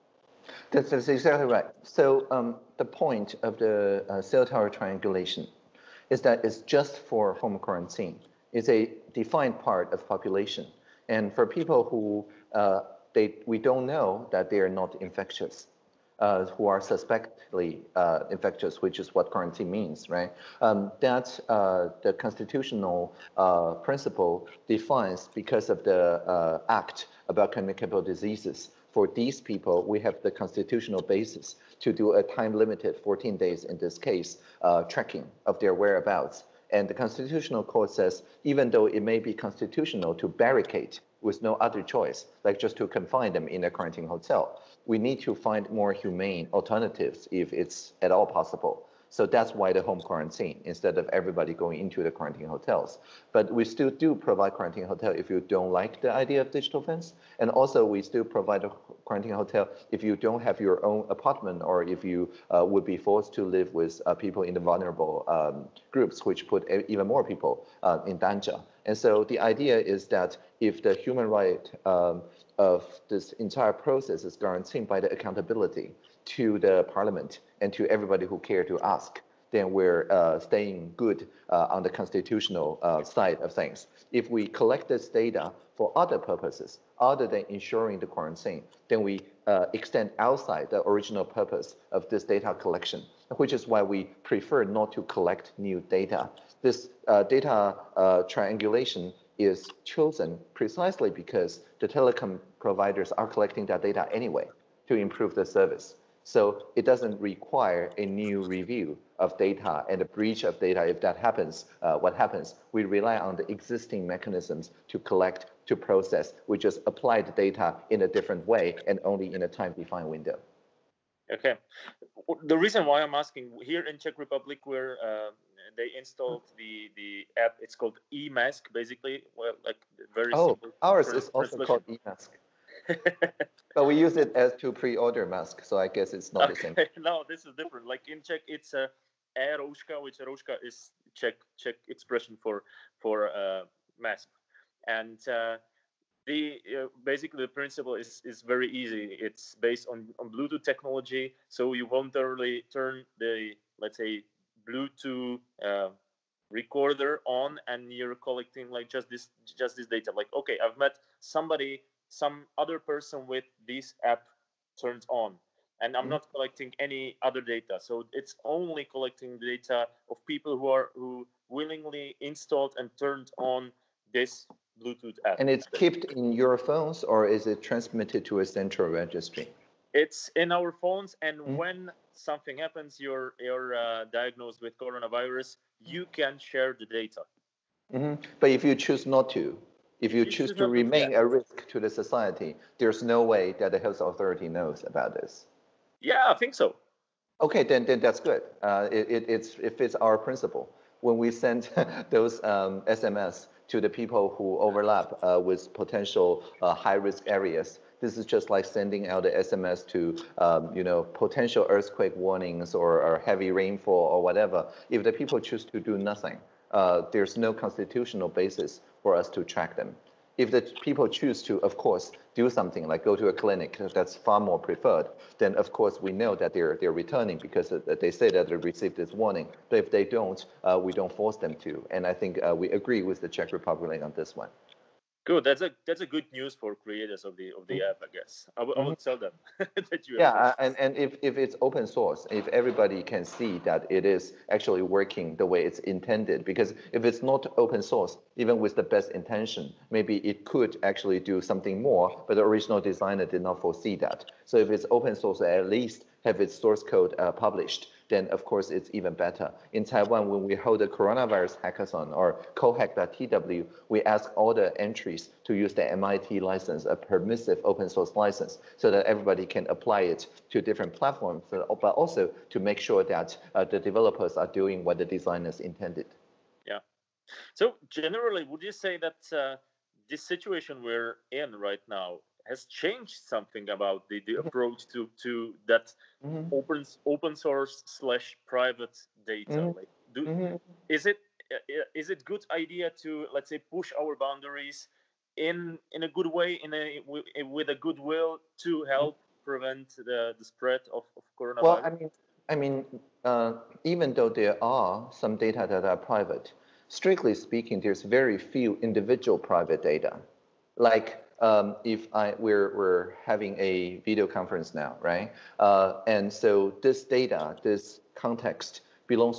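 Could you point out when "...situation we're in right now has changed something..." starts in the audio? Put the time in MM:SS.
04:40.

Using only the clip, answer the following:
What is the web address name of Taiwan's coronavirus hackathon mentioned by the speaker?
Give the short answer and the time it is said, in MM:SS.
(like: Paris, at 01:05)
cohack.tw, at 04:22.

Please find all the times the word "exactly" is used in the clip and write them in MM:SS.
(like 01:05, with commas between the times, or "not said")
00:01.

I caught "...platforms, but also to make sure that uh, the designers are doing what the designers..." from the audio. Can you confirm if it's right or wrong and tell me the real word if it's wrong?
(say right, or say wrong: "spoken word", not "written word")
wrong: "developers", not "designers".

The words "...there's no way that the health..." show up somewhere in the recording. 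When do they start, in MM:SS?
03:12.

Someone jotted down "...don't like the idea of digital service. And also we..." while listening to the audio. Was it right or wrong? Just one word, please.
wrong.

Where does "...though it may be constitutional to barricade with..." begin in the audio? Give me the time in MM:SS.
00:38.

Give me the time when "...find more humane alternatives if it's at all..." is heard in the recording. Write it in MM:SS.
00:45.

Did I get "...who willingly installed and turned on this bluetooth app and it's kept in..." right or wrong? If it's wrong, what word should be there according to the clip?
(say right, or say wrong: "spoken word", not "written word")
right.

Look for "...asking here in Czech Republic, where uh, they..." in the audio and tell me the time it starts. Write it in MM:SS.
02:03.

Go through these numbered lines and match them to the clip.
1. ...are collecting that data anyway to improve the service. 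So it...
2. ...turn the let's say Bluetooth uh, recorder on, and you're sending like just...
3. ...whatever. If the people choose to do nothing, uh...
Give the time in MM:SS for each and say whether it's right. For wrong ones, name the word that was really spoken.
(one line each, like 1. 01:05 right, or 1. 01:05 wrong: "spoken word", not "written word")
1. 01:43 right
2. 02:32 wrong: "collecting", not "sending"
3. 03:34 right.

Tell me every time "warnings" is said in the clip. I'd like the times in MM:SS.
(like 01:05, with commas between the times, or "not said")
03:32, 03:49.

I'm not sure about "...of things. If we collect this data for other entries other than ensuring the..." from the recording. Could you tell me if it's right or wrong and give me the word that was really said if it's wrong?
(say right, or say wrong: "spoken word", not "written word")
wrong: "purposes", not "entries".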